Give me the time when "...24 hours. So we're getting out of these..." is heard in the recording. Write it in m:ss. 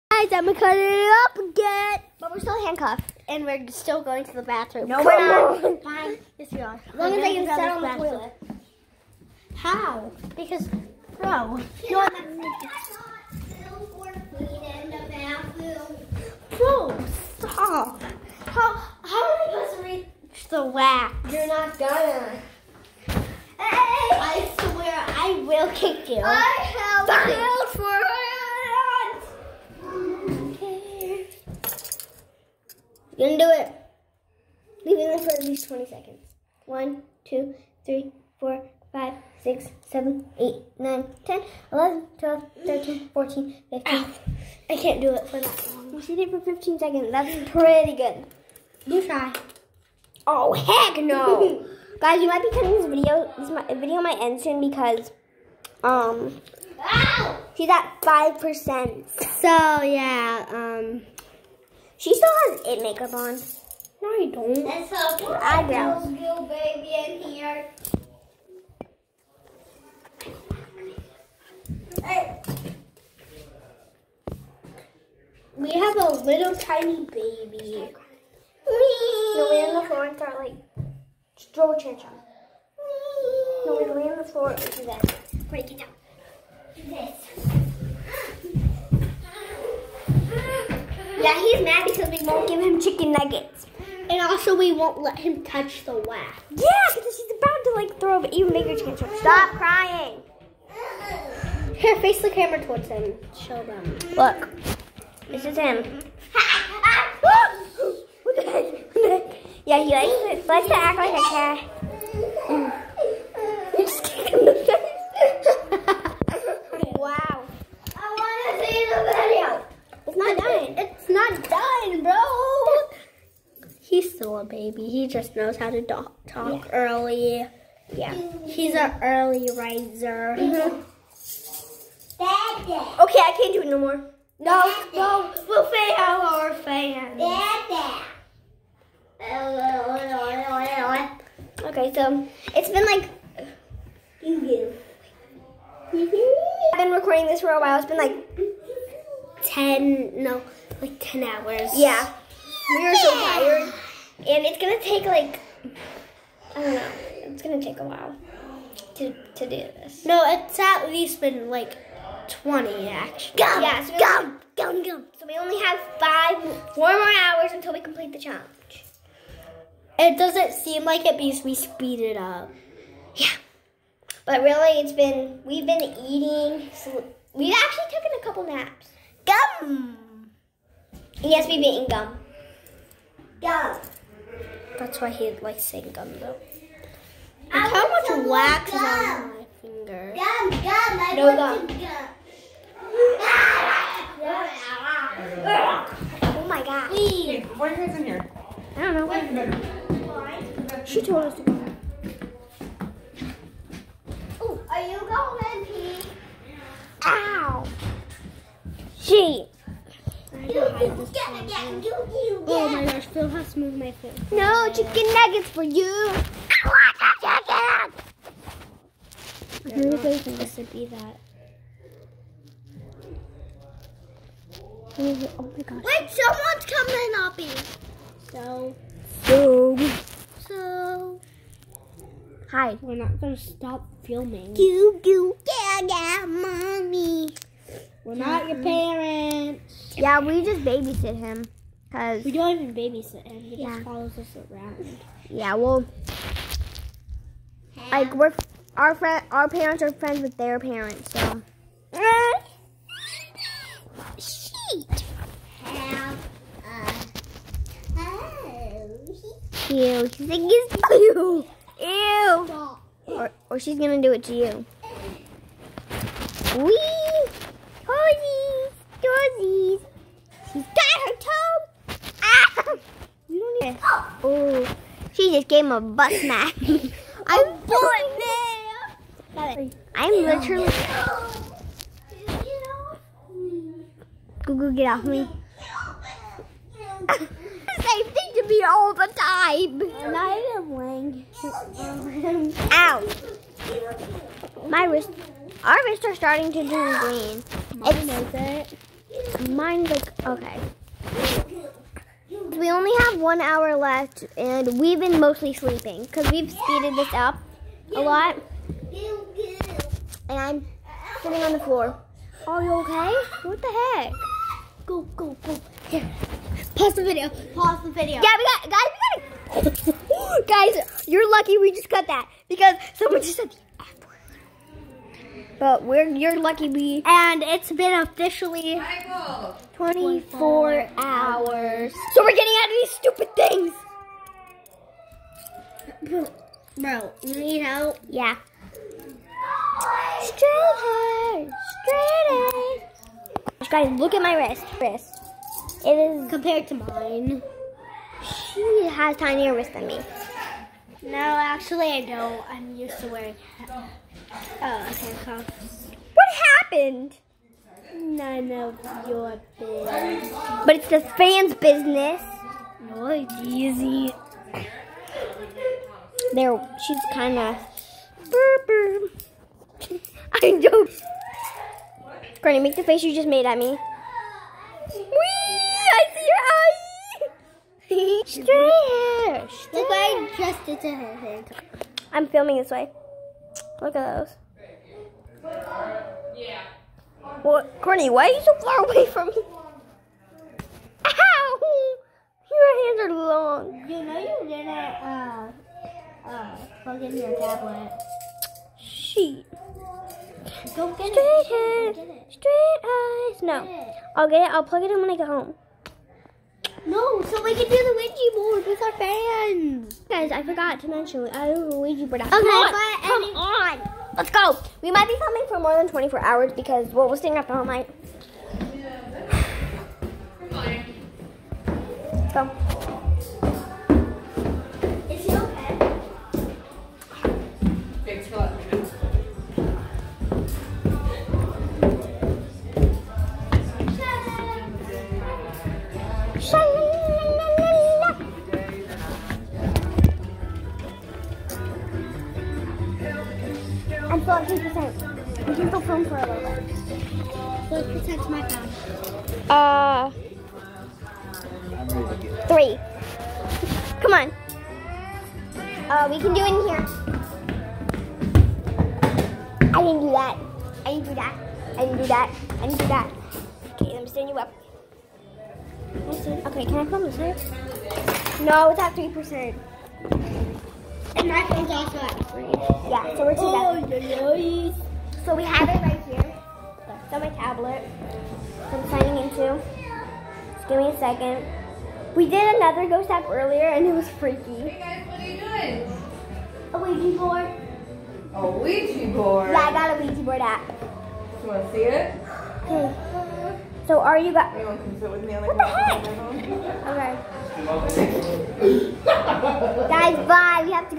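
5:29.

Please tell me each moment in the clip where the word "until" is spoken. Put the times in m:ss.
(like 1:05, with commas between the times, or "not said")
2:47.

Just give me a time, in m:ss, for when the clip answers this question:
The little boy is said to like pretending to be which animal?
1:50.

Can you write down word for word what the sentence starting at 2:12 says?
Okay, I can't do it no more.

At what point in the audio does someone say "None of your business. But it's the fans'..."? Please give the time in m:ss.
5:57.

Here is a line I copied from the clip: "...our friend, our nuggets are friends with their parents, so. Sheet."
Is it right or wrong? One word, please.
wrong.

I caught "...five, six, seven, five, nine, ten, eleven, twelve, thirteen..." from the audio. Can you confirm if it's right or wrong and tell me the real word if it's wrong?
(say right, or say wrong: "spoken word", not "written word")
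wrong: "eight", not "five".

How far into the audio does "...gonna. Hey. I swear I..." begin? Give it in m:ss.
0:21.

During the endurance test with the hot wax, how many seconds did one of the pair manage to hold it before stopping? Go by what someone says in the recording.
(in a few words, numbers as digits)
15.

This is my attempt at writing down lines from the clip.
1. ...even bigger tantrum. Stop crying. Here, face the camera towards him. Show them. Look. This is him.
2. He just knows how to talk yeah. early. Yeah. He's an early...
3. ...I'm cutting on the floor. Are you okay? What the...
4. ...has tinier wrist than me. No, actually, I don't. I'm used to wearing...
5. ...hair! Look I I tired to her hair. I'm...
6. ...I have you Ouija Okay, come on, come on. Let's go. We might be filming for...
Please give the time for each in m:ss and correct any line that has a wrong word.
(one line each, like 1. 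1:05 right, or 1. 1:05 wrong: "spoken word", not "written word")
1. 1:38 right
2. 2:04 right
3. 5:10 wrong: "sitting", not "cutting"
4. 5:48 right
5. 6:18 wrong: "adjusted", not "tired"
6. 6:51 right.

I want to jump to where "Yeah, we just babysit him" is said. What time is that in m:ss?
3:59.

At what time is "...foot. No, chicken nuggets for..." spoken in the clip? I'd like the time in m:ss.
3:33.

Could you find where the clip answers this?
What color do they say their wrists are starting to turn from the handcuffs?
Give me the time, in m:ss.
4:56.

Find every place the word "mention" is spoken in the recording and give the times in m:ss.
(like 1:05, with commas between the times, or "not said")
6:50.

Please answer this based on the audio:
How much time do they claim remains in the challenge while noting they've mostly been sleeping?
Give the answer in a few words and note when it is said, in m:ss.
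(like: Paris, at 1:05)
1 hour, at 5:03.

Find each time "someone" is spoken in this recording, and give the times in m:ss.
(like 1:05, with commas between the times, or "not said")
3:46, 5:22.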